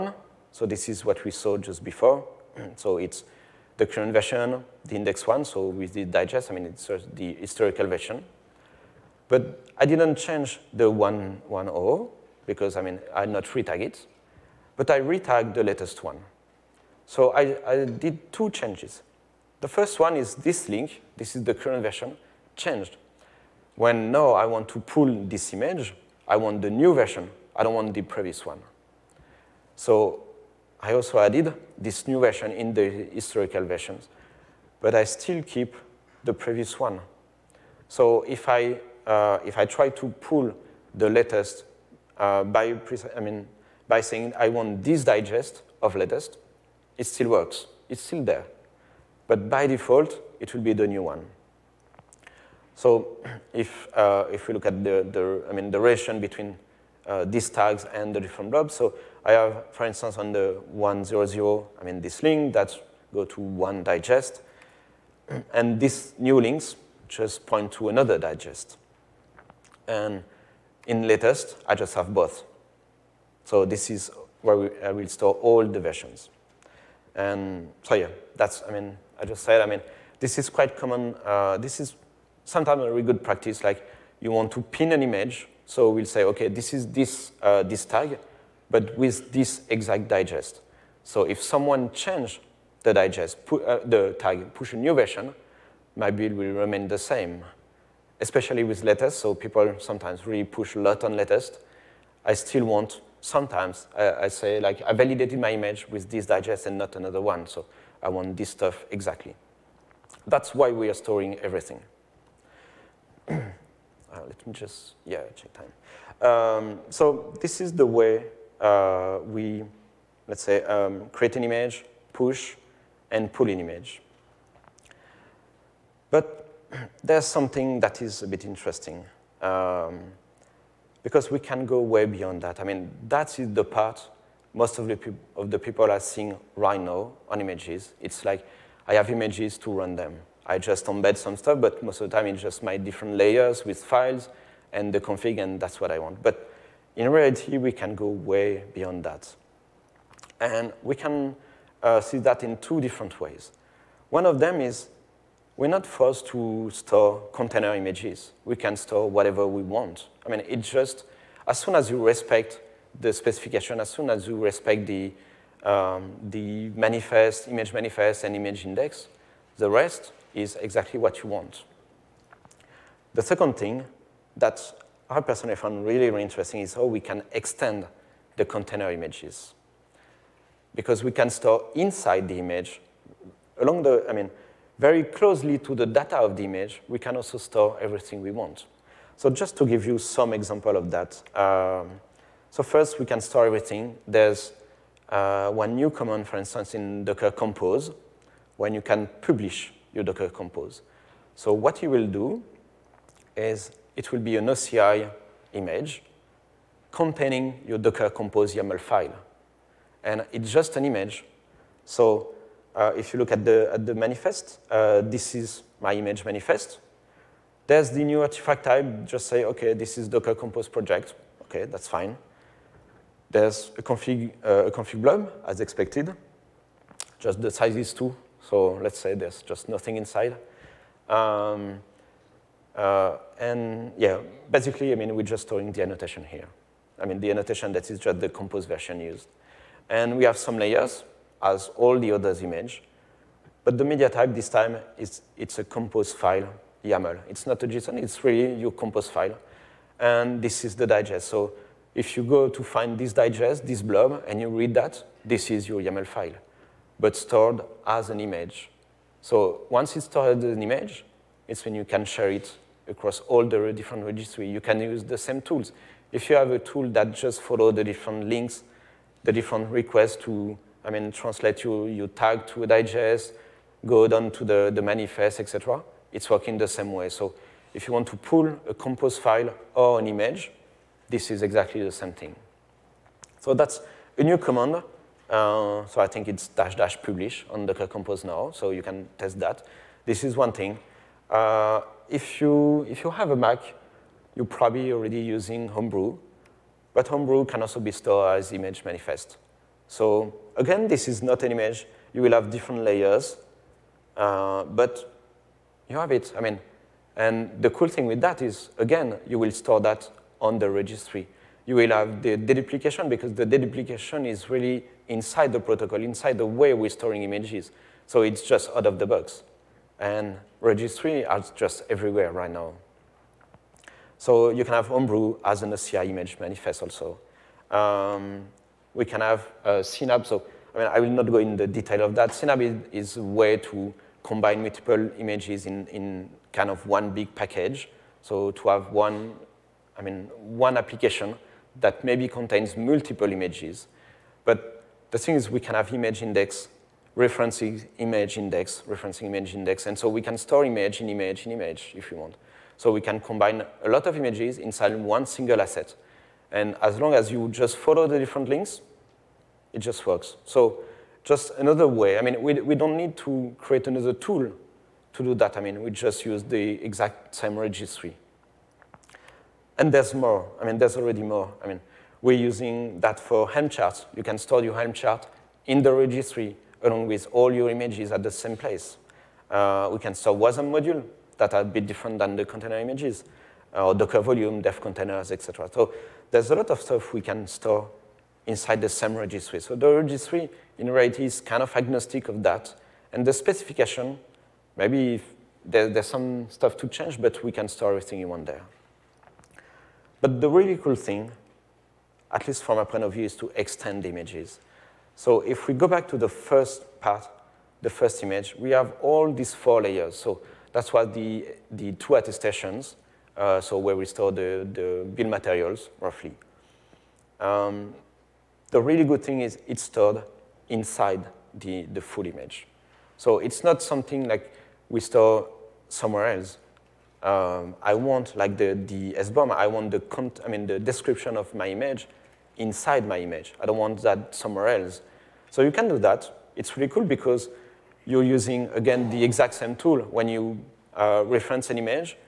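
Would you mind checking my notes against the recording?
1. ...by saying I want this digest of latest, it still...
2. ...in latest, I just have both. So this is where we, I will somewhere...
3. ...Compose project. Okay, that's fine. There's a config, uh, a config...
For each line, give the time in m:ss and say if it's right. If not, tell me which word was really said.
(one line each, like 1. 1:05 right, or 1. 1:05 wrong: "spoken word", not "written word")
1. 0:43 right
2. 1:10 wrong: "store", not "somewhere"
3. 3:40 right.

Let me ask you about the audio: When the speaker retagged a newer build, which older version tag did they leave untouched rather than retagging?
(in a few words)
110.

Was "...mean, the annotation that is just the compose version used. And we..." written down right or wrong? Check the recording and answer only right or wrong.
right.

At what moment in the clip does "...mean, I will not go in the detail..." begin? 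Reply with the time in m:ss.
5:30.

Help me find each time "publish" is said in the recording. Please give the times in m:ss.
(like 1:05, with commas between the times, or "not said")
3:19, 4:47.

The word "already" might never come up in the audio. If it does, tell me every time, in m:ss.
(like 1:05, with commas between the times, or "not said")
4:54, 6:10.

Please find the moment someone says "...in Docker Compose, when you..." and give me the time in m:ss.
3:16.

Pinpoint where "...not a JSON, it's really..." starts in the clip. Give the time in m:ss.
4:07.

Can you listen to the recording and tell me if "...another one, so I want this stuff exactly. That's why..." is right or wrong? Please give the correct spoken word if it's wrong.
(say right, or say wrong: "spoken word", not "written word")
right.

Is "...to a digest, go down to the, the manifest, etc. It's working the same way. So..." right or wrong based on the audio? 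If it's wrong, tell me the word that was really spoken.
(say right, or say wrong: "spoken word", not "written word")
right.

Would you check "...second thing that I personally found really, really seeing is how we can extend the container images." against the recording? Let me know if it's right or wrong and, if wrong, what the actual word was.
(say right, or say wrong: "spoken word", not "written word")
wrong: "interesting", not "seeing".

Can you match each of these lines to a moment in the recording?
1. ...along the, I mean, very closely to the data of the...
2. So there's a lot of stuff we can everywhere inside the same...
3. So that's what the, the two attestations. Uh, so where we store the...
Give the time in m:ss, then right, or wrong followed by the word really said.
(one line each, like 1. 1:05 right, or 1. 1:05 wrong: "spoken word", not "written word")
1. 3:03 right
2. 6:25 wrong: "store", not "everywhere"
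3. 6:50 right.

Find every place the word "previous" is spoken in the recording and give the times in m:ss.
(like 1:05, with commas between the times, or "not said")
0:28, 0:36.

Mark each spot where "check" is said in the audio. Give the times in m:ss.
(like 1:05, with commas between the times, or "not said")
1:55.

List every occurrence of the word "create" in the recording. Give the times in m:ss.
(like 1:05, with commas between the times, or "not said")
2:01, 6:03.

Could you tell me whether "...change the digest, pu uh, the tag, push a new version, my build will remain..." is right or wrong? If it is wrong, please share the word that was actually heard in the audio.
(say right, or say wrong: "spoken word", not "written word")
right.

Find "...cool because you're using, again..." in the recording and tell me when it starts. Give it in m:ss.
7:16.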